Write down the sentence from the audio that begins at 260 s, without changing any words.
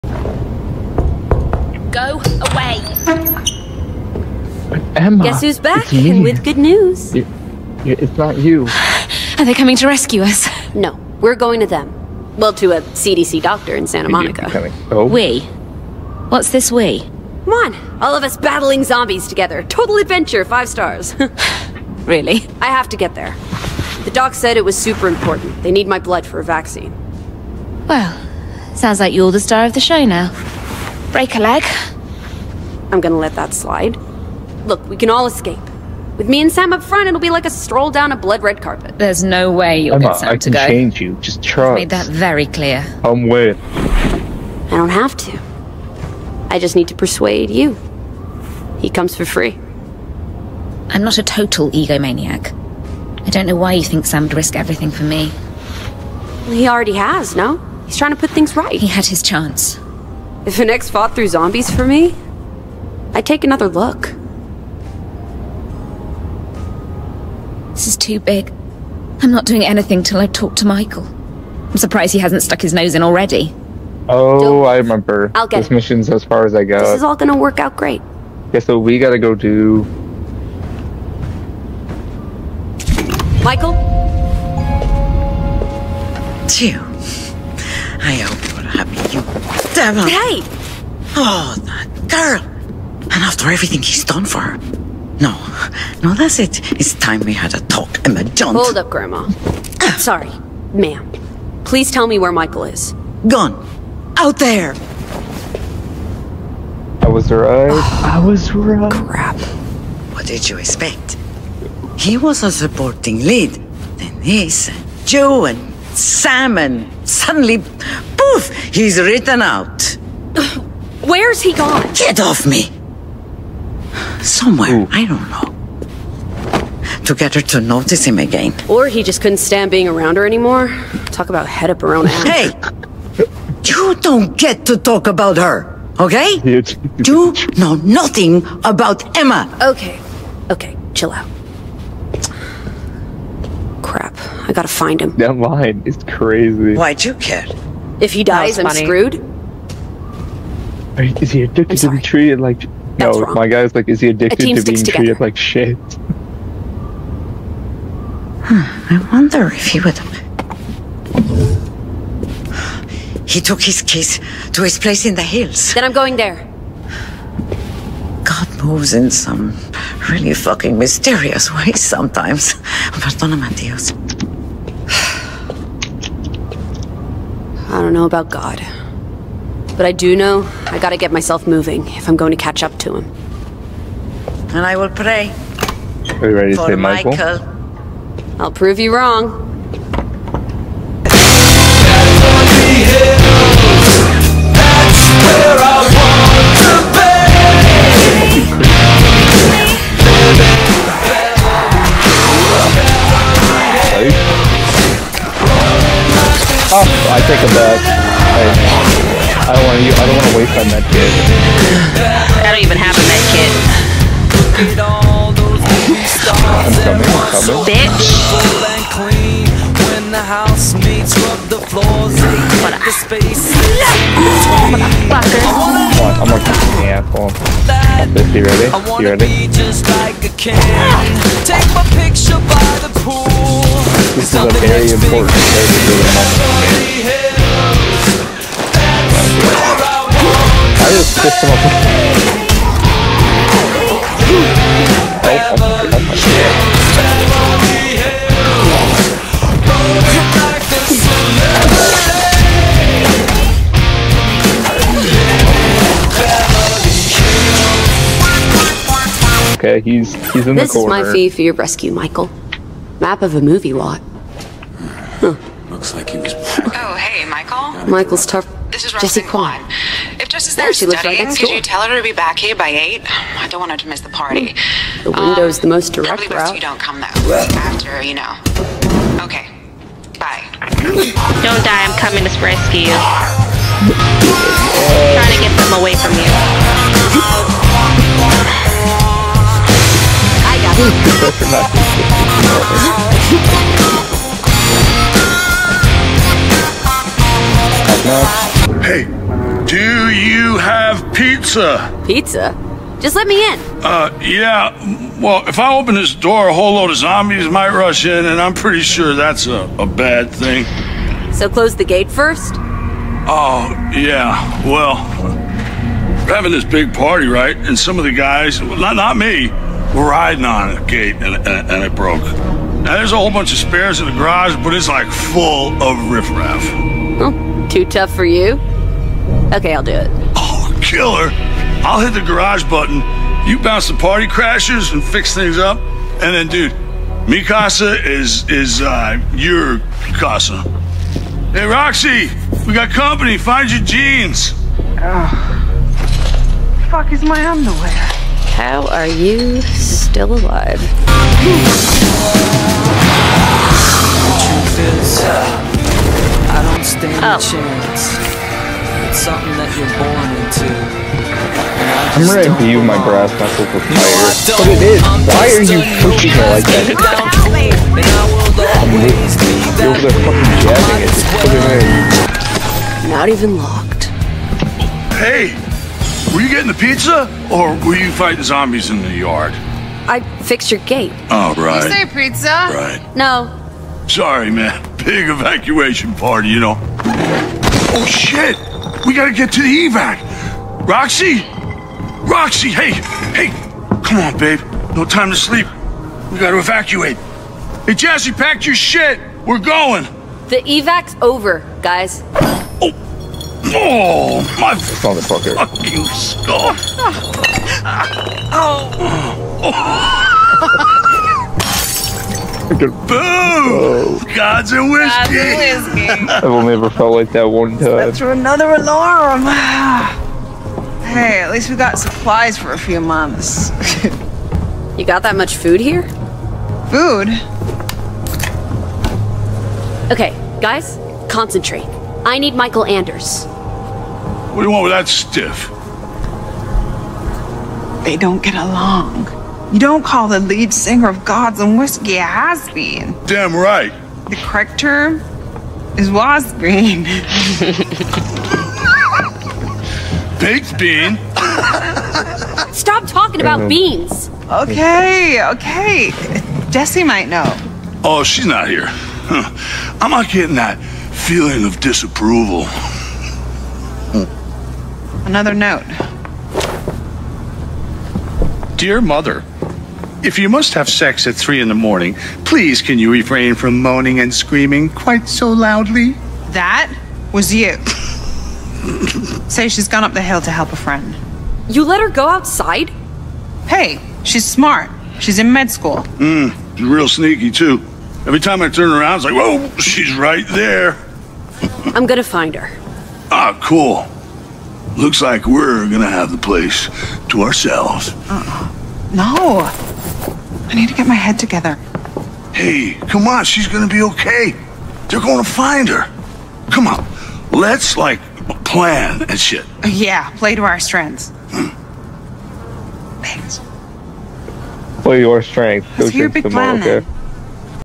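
This is my fee for your rescue, Michael.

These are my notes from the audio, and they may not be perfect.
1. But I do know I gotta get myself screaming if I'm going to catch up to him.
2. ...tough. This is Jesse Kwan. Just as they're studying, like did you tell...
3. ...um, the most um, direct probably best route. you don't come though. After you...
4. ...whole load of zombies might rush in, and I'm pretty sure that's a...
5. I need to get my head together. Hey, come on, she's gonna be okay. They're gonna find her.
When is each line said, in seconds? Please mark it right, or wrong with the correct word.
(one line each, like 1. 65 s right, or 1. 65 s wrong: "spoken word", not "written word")
1. 179 s wrong: "moving", not "screaming"
2. 268 s right
3. 275 s right
4. 306 s right
5. 500 s right.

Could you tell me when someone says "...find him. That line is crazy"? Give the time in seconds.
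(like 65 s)
144 s.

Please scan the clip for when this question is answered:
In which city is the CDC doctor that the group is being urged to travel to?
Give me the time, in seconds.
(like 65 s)
13 s.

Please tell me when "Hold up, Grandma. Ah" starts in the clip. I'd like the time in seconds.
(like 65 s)
98 s.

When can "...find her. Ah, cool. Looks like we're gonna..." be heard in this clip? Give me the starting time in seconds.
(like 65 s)
492 s.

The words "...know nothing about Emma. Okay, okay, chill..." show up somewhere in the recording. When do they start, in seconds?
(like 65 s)
137 s.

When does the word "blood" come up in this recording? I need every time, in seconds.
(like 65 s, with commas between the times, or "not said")
25 s, 38 s.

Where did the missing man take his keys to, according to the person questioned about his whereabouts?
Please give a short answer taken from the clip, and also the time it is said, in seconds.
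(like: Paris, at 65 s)
His place in the hills, at 164 s.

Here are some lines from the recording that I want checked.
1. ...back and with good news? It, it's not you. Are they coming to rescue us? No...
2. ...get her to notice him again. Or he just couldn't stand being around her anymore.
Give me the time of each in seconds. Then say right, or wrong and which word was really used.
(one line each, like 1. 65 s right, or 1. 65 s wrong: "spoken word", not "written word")
1. 5 s right
2. 127 s right.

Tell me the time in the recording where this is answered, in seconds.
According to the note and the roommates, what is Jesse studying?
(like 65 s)
485 s.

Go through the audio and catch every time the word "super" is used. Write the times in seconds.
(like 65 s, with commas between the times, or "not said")
24 s.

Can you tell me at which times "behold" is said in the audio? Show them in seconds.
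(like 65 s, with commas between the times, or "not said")
not said.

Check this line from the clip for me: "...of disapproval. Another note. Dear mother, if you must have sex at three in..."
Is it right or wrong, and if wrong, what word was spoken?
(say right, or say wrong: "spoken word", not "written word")
right.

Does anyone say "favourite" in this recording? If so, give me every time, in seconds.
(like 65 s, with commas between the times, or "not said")
not said.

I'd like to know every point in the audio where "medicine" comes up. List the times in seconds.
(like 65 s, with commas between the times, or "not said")
not said.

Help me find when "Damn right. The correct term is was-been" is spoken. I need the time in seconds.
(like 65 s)
443 s.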